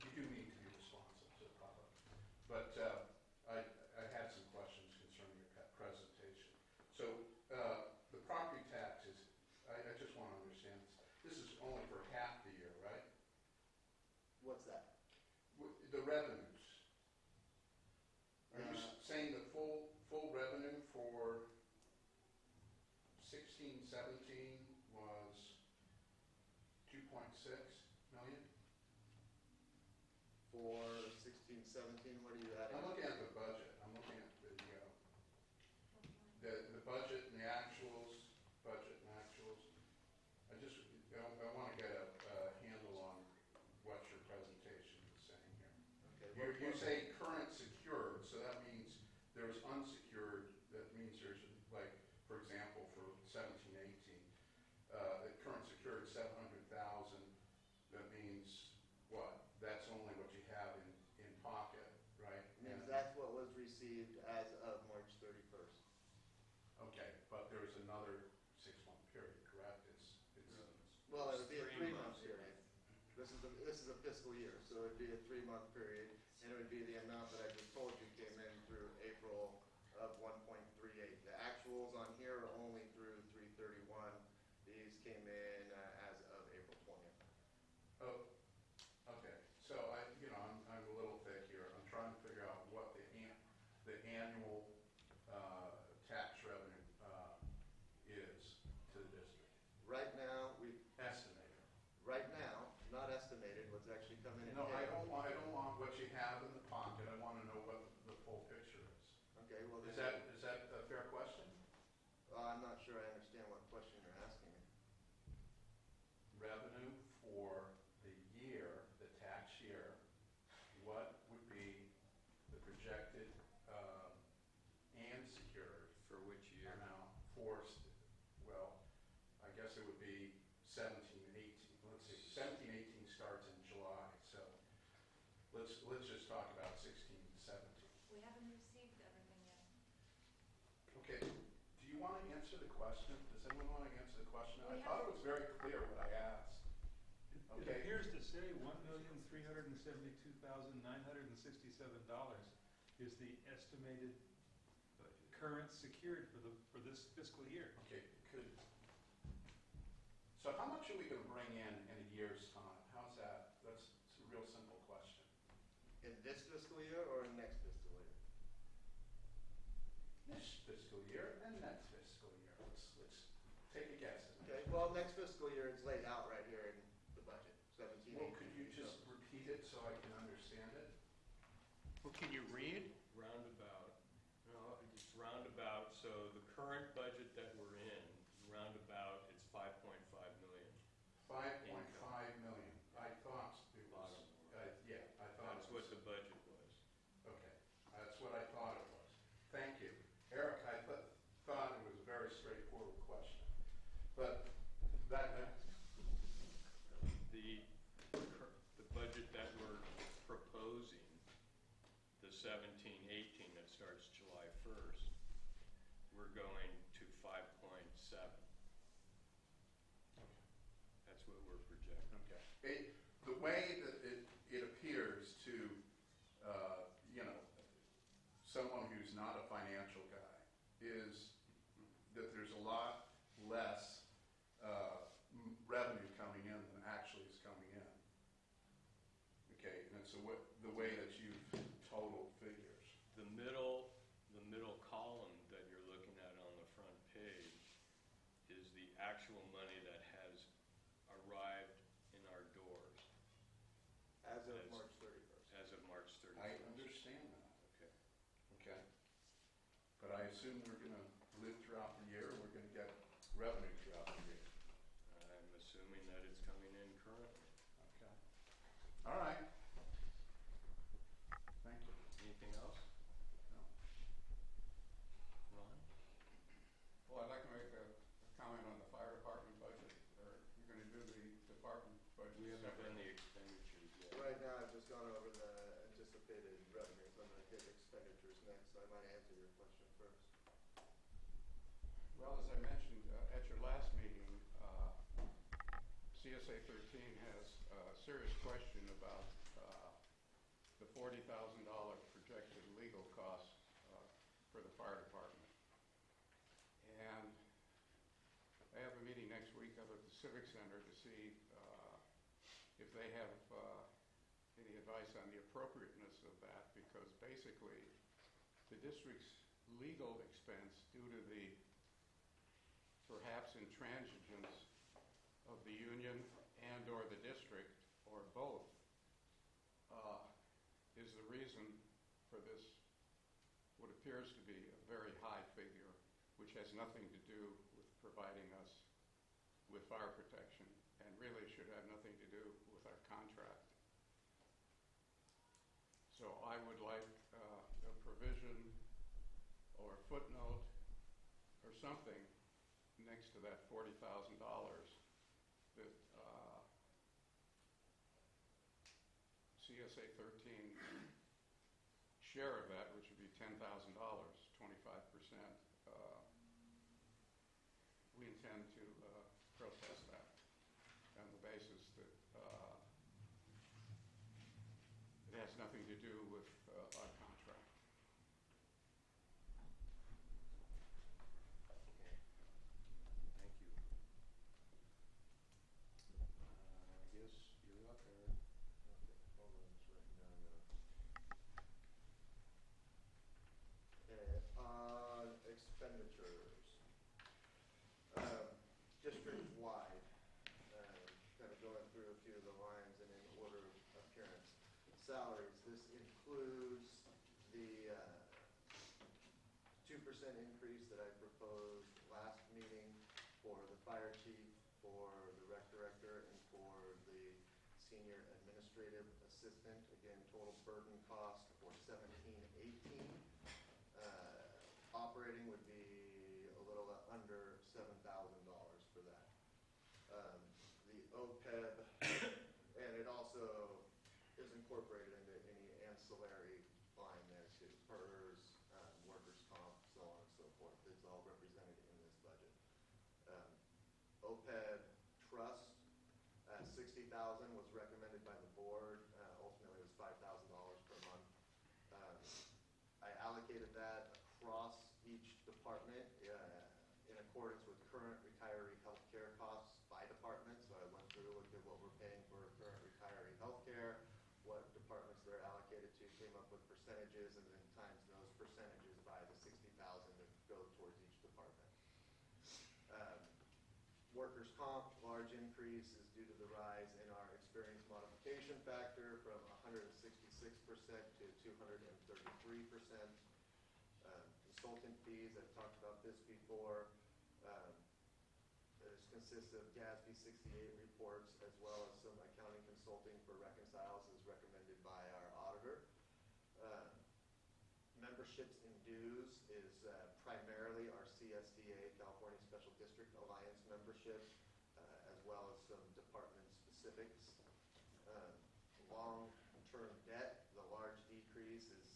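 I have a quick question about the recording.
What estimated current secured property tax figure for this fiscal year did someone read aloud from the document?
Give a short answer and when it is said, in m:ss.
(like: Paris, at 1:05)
$1,372,967, at 2:28.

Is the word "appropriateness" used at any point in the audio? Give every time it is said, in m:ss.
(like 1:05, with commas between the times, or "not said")
5:15.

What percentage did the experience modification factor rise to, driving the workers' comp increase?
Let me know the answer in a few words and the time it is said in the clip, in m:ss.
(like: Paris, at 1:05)
233%, at 8:01.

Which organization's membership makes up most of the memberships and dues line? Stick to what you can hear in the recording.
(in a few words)
California Special District Alliance.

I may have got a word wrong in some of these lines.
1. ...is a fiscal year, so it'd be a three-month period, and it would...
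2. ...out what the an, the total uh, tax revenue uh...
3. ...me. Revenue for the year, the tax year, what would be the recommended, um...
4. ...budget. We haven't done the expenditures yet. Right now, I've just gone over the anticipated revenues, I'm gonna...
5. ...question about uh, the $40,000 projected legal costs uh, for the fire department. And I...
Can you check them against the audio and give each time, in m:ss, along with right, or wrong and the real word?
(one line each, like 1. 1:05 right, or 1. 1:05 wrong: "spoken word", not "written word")
1. 1:13 right
2. 1:32 wrong: "annual", not "total"
3. 1:54 wrong: "projected", not "recommended"
4. 4:42 right
5. 4:58 right.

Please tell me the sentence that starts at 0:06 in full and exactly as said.
So uh, the property tax is, I, I just want to understand this.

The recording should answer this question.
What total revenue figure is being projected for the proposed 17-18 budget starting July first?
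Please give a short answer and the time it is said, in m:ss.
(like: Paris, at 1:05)
5.7 million, at 3:37.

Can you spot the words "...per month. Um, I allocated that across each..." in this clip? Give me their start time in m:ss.
7:30.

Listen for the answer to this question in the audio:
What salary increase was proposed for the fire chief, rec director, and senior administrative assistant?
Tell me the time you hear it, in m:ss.
6:49.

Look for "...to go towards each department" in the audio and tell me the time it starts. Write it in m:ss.
7:50.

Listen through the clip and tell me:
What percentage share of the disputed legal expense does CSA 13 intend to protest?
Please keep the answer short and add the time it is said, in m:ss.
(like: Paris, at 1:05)
25%, at 6:03.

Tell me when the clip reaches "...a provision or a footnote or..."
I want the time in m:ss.
5:47.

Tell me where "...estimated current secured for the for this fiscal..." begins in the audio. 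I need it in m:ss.
2:33.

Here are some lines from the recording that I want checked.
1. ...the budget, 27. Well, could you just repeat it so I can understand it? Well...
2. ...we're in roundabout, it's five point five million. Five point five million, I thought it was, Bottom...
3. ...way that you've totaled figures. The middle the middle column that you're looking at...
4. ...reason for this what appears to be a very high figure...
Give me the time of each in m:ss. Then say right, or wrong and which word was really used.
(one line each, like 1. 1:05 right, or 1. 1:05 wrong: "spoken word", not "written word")
1. 2:57 wrong: "17", not "27"
2. 3:07 right
3. 4:00 right
4. 5:31 right.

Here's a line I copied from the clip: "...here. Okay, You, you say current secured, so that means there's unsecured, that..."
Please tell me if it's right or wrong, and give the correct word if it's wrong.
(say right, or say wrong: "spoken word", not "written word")
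right.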